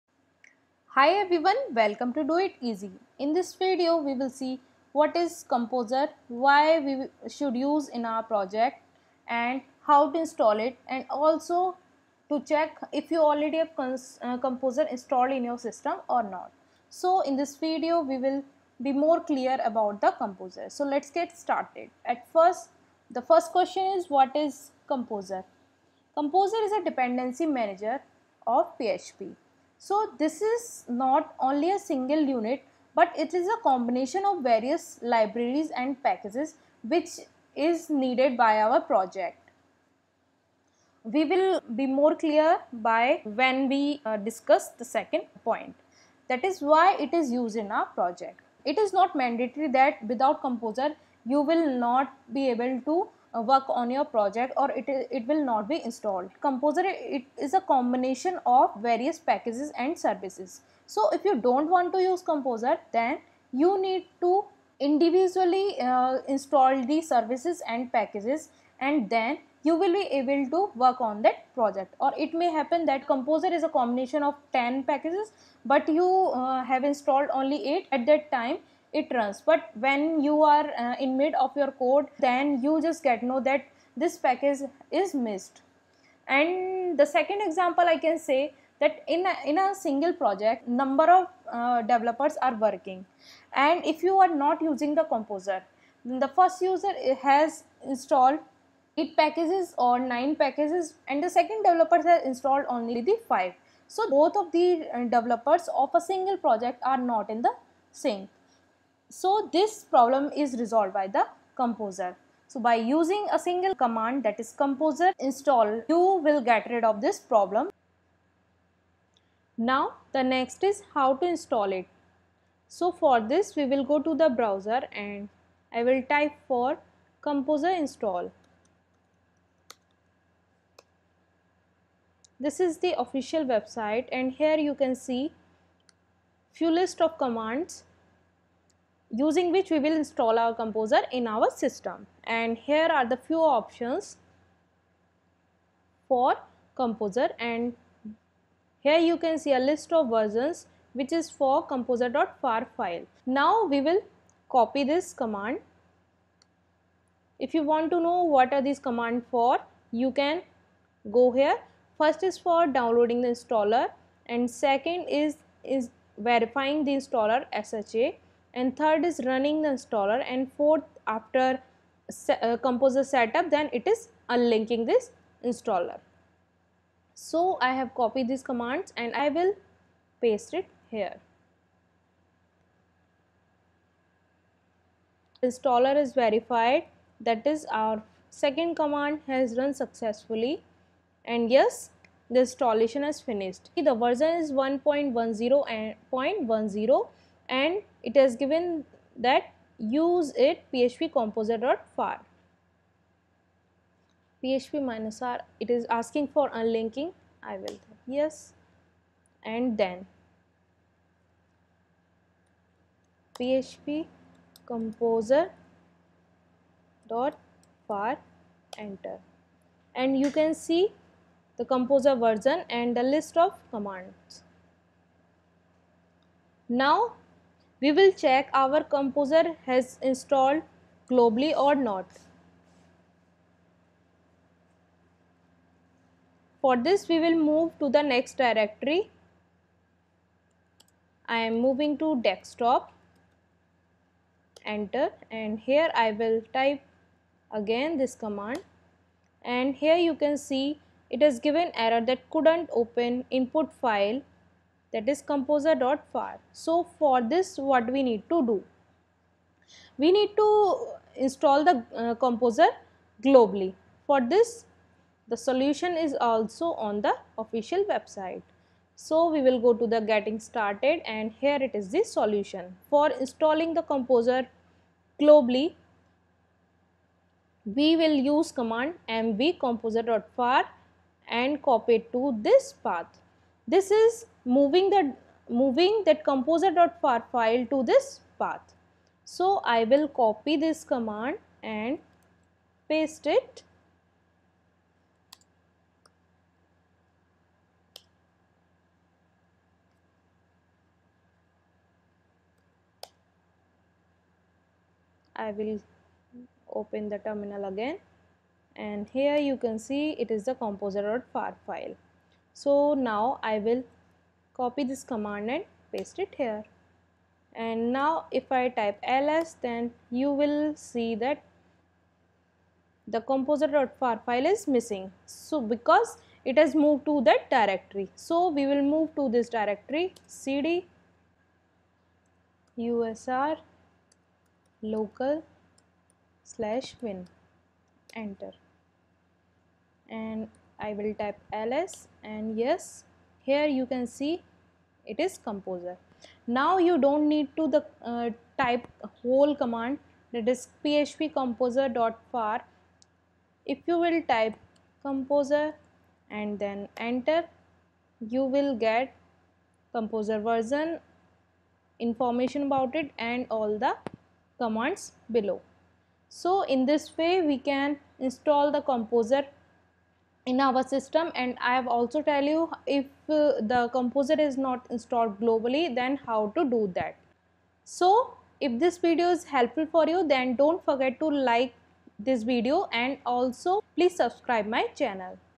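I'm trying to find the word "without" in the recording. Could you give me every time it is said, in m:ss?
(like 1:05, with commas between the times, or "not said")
0:50.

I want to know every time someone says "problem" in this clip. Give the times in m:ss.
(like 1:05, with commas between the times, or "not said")
1:49, 1:57.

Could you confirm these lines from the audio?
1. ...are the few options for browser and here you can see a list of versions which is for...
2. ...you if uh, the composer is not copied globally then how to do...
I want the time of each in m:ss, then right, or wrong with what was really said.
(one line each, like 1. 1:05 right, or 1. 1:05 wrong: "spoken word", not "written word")
1. 2:22 wrong: "composer", not "browser"
2. 6:12 wrong: "installed", not "copied".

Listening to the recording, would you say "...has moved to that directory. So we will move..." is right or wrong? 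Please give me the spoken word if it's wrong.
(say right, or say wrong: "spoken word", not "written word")
right.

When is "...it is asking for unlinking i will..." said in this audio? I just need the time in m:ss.
3:25.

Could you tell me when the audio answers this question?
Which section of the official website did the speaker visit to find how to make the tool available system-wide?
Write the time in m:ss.
4:30.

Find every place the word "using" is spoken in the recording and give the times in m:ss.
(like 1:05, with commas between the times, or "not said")
1:34, 1:52, 2:19.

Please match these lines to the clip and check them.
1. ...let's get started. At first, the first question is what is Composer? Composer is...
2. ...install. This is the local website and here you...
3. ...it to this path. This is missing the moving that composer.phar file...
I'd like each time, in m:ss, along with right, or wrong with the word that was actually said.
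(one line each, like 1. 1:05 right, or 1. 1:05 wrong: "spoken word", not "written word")
1. 0:20 right
2. 2:07 wrong: "official", not "local"
3. 4:41 wrong: "moving", not "missing".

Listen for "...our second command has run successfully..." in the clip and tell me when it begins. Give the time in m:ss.
3:07.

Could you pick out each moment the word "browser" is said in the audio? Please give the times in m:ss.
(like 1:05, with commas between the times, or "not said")
2:04.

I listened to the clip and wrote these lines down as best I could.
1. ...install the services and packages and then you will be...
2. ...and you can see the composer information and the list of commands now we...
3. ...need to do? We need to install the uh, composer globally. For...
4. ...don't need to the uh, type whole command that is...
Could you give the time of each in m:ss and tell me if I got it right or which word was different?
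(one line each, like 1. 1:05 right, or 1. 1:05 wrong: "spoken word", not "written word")
1. 1:06 right
2. 3:39 wrong: "version", not "information"
3. 4:18 right
4. 5:46 right.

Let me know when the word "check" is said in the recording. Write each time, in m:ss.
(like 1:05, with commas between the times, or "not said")
0:12, 3:48.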